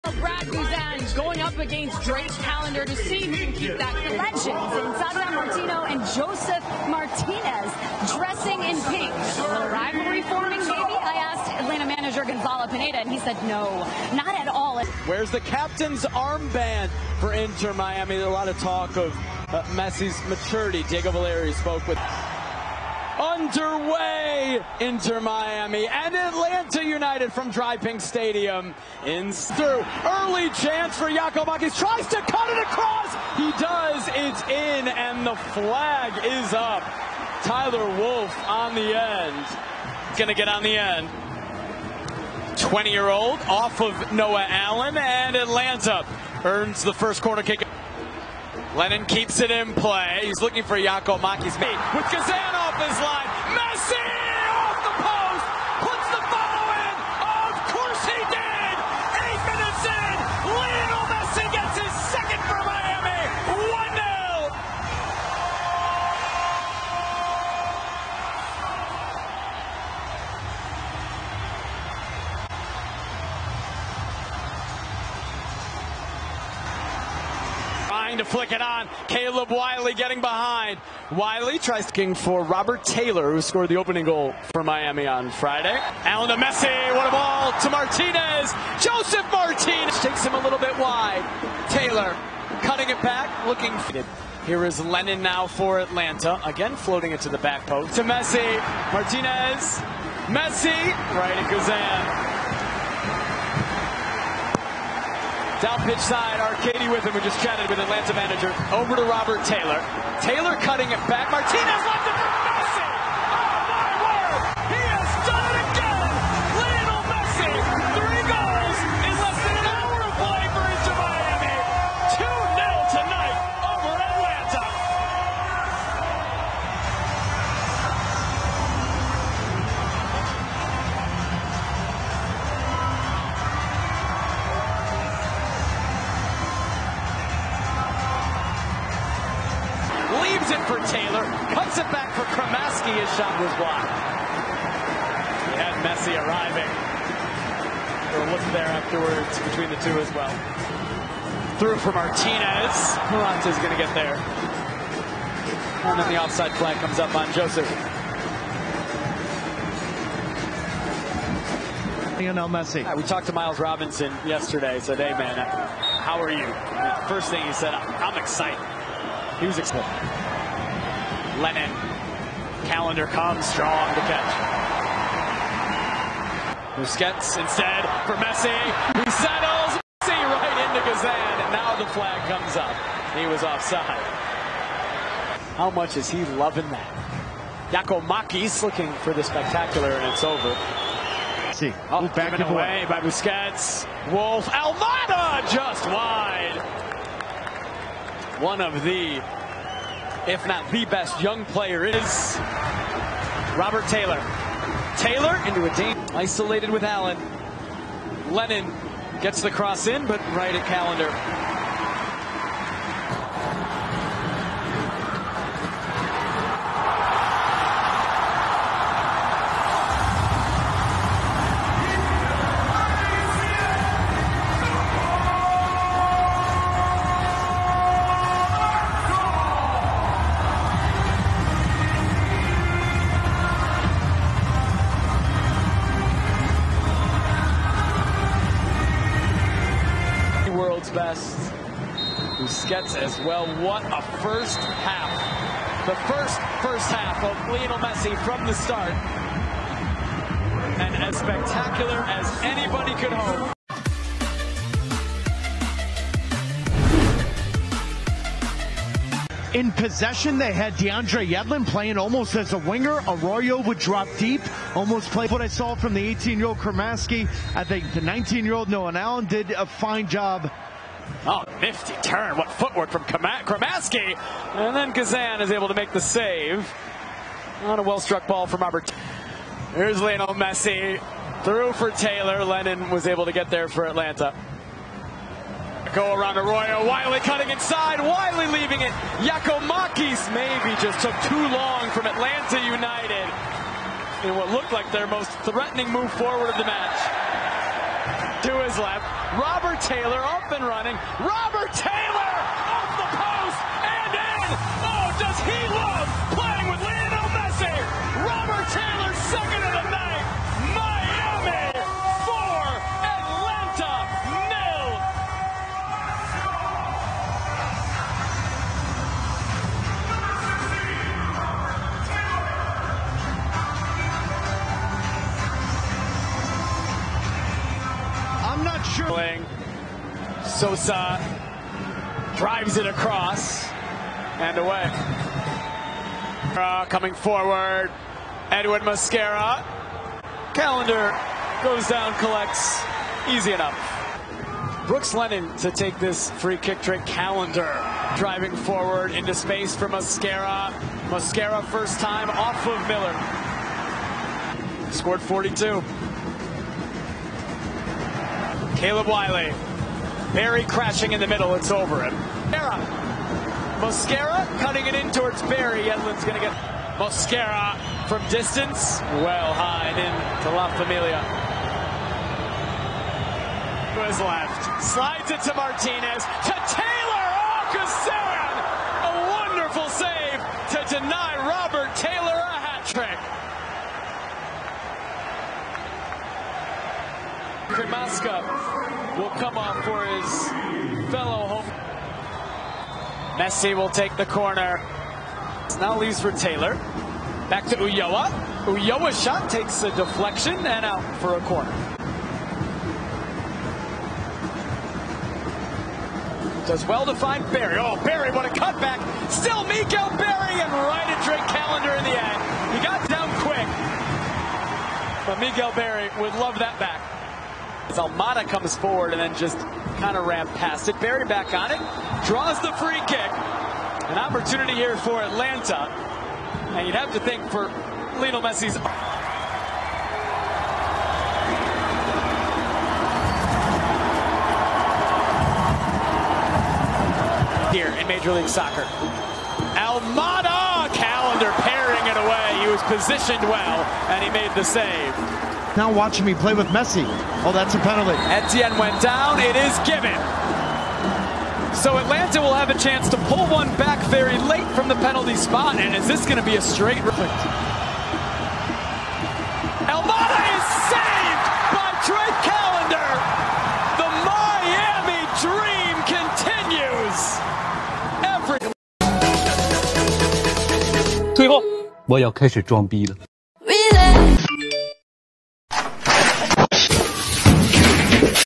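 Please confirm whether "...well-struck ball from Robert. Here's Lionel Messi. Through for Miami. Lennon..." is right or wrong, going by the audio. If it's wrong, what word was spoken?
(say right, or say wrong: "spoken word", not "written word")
wrong: "Taylor", not "Miami".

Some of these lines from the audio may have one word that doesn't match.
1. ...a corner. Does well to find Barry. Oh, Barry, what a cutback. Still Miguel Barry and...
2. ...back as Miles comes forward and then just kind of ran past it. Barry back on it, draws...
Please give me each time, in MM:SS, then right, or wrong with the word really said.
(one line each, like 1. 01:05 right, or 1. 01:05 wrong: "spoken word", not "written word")
1. 06:41 right
2. 06:56 wrong: "Almada", not "Miles".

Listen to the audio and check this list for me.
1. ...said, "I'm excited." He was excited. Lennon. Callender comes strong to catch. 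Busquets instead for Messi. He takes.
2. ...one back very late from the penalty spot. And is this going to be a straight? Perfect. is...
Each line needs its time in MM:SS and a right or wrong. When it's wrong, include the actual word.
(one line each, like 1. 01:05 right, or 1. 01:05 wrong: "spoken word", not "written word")
1. 02:47 wrong: "settles", not "takes"
2. 07:33 right.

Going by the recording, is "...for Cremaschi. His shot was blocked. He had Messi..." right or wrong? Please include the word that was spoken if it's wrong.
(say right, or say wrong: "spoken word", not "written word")
right.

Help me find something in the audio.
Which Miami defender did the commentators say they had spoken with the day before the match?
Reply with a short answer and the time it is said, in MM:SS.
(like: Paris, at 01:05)
Miles Robinson, at 02:43.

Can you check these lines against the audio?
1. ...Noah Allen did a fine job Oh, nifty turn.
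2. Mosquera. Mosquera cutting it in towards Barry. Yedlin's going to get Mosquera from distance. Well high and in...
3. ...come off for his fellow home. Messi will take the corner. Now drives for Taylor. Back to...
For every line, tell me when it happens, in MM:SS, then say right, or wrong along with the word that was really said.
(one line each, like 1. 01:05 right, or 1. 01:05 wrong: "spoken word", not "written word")
1. 04:28 right
2. 06:02 right
3. 06:29 wrong: "leaves", not "drives".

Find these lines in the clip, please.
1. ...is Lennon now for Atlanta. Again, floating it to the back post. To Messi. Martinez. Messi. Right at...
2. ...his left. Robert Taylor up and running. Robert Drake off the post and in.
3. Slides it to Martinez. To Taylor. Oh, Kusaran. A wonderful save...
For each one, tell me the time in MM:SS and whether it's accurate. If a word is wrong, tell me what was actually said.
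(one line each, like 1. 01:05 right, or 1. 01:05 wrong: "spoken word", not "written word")
1. 01:34 right
2. 04:58 wrong: "Taylor", not "Drake"
3. 06:14 right.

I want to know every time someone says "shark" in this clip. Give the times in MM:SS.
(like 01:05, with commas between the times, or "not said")
not said.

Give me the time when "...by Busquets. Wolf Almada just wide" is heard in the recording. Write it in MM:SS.
03:12.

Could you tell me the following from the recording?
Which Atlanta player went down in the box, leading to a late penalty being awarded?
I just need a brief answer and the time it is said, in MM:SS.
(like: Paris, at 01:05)
Etienne, at 07:28.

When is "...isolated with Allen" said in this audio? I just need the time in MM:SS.
03:26.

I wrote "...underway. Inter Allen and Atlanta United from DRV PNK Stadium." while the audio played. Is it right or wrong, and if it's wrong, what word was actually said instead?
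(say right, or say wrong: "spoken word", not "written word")
wrong: "Miami", not "Allen".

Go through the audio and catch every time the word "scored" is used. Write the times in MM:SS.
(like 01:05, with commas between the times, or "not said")
01:23, 05:54.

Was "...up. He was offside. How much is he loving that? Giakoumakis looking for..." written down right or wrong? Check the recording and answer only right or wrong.
right.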